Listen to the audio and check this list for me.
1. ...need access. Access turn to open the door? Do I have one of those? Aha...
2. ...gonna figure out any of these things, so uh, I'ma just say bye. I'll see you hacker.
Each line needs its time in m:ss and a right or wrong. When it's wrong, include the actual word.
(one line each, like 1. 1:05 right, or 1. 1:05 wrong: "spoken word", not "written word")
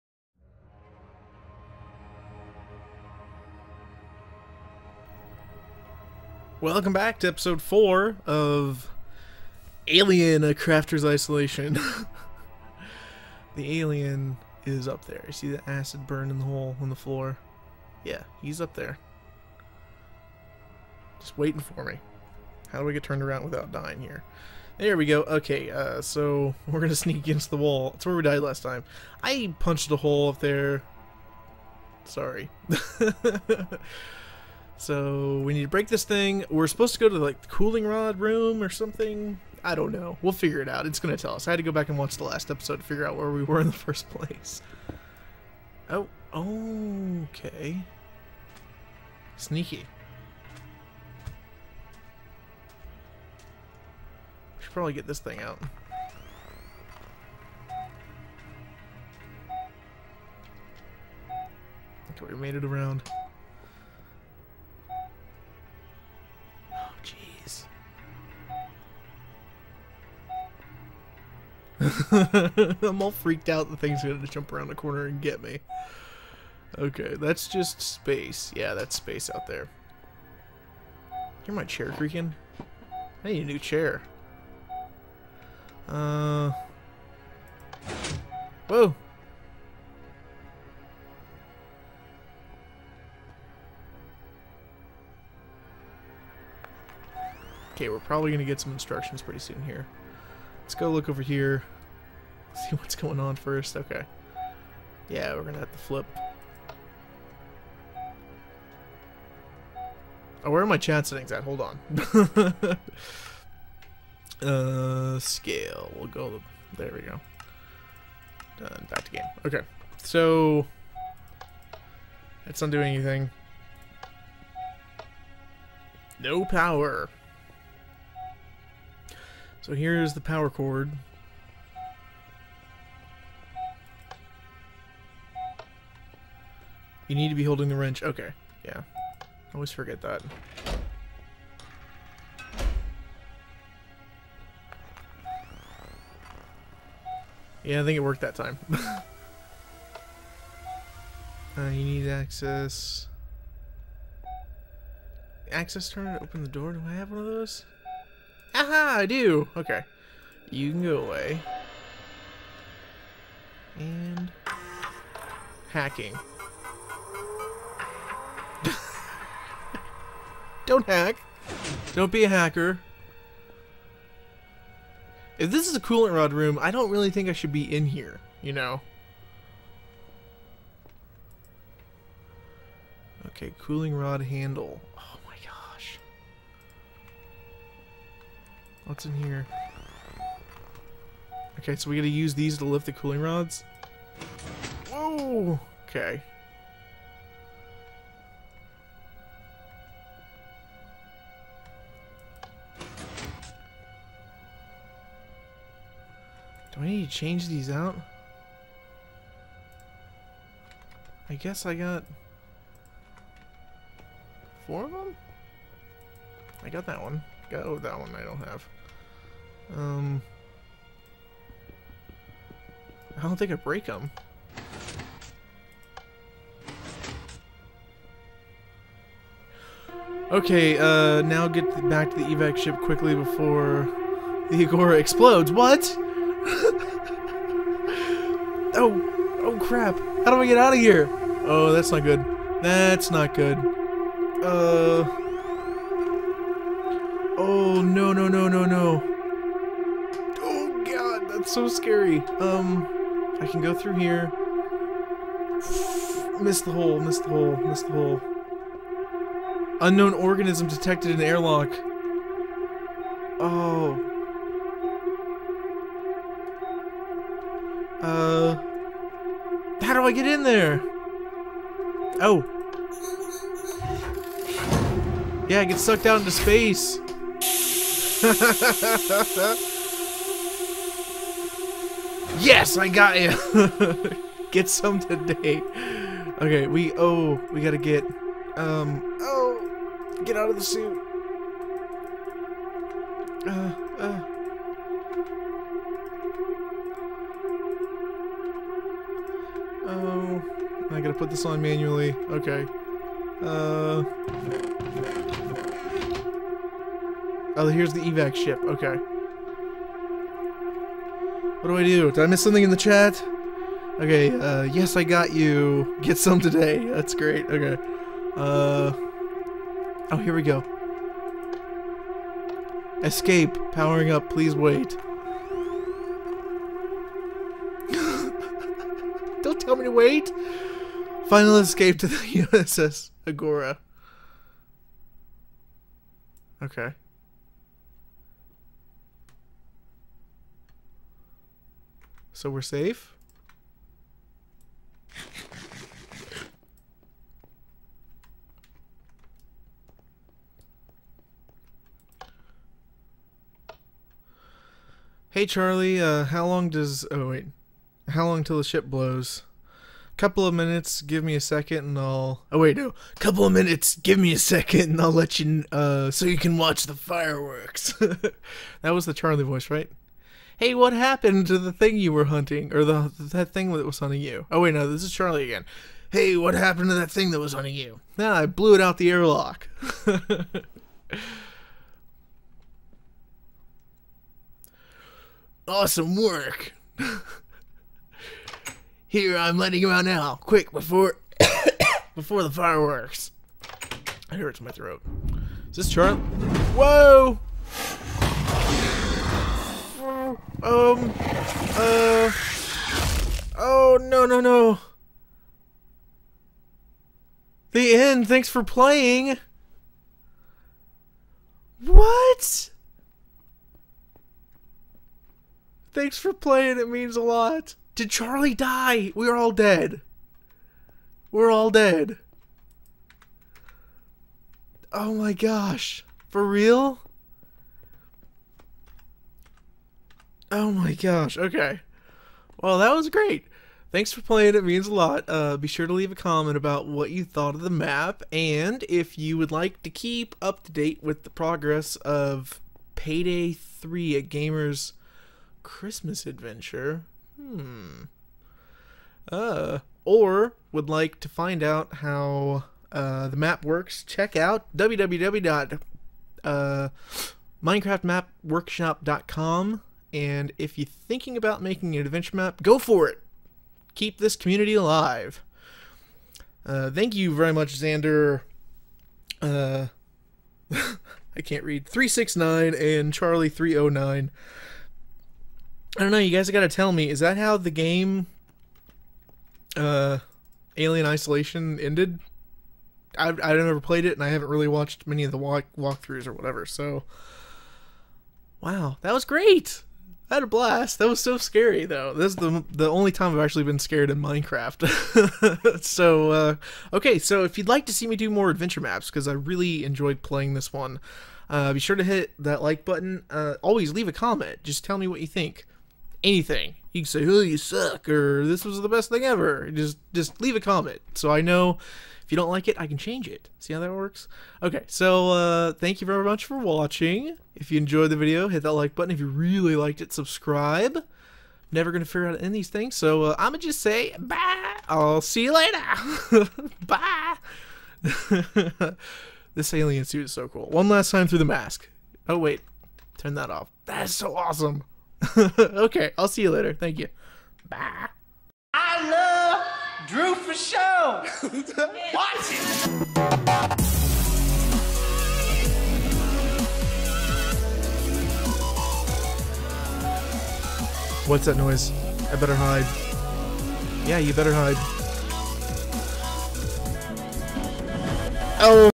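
1. 2:31 right
2. 8:41 wrong: "later", not "hacker".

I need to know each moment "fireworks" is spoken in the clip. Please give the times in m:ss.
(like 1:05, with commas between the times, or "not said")
6:06, 6:32.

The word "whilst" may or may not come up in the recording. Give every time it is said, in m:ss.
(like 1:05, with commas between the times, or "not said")
not said.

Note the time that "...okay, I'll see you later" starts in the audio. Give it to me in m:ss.
8:55.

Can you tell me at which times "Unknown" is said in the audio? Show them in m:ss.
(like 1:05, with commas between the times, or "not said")
4:19.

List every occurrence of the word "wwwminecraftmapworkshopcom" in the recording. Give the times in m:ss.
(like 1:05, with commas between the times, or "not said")
7:34.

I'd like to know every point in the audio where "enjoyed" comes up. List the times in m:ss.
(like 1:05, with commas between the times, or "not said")
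8:19, 8:37.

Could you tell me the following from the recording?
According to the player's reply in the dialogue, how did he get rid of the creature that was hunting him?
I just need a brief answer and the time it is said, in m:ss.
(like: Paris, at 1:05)
Blew it out the airlock, at 6:18.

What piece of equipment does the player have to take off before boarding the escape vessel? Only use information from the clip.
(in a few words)
The suit.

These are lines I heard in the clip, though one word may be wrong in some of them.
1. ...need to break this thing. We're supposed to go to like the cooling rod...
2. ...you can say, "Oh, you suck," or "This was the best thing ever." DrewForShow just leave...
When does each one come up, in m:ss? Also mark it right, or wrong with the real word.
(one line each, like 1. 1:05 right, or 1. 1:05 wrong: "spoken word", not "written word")
1. 0:35 right
2. 8:26 wrong: "Just", not "DrewForShow".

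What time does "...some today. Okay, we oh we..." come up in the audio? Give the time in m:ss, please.
4:44.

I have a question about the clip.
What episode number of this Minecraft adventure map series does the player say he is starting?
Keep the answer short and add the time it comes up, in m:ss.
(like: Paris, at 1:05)
4, at 0:07.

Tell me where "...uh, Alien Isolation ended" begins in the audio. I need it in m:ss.
7:59.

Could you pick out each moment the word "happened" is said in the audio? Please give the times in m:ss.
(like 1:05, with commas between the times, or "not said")
6:10, 6:16.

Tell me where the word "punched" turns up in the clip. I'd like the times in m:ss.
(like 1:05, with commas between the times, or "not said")
0:29.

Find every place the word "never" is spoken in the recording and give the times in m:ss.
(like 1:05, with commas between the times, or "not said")
8:03, 8:41.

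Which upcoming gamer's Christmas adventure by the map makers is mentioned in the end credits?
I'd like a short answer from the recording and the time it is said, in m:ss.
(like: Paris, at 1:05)
Payday 3, at 7:22.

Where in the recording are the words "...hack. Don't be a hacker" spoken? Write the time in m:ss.
2:50.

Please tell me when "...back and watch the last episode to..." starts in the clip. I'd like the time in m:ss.
0:41.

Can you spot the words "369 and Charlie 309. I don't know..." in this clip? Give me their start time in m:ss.
7:51.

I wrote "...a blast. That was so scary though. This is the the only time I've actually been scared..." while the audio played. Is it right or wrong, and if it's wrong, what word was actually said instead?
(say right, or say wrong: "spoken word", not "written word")
right.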